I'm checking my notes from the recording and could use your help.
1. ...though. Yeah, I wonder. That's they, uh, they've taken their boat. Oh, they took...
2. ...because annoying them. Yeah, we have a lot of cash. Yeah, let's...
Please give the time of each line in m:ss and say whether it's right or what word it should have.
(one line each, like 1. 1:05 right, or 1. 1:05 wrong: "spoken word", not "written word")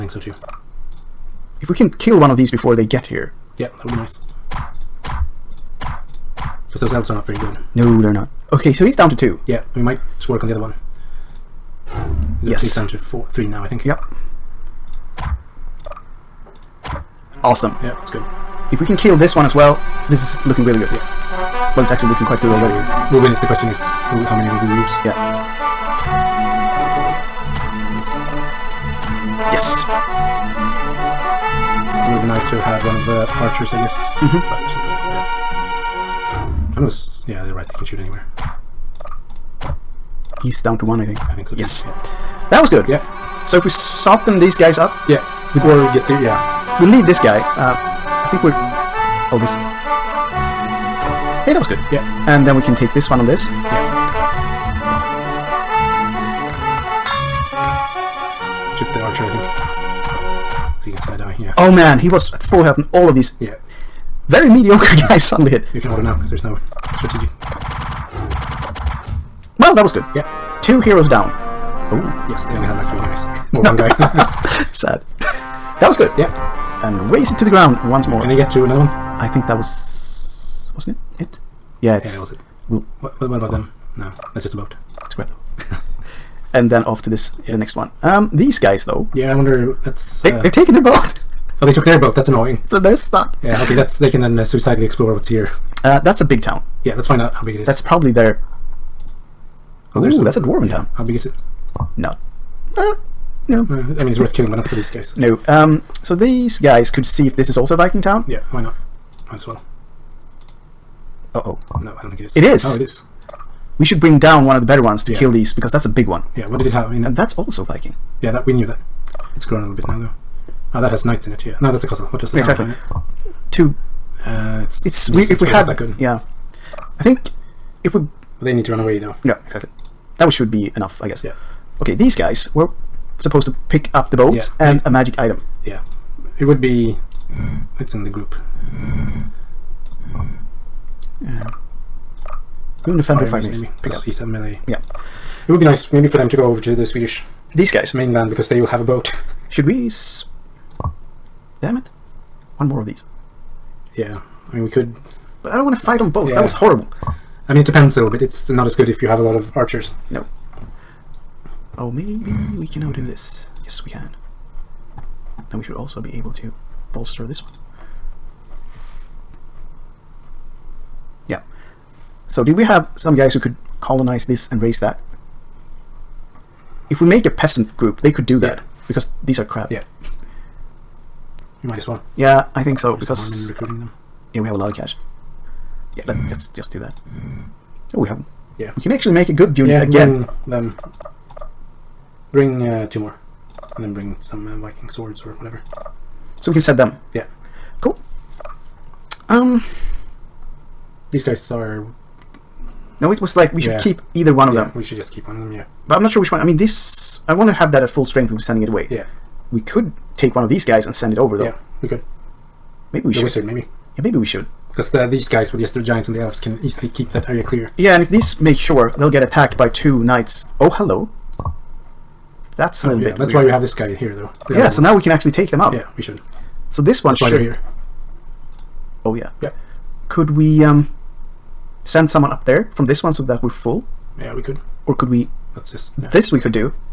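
1. 1:28 right
2. 3:03 wrong: "recruiting", not "annoying".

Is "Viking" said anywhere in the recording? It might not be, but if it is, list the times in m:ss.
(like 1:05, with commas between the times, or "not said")
1:47, 1:57, 3:14.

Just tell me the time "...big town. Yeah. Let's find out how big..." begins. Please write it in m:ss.
1:36.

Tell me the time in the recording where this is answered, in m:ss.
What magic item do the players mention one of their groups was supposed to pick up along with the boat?
2:22.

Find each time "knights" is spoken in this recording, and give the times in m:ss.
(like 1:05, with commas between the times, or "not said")
2:01, 3:40.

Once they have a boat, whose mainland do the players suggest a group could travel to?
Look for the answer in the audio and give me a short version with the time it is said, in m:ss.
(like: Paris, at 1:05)
The Swedish, at 2:26.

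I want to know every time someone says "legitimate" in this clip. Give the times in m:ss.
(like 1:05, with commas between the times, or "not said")
not said.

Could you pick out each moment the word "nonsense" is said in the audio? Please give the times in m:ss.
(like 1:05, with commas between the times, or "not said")
not said.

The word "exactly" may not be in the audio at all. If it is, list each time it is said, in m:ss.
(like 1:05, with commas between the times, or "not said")
2:02, 2:09.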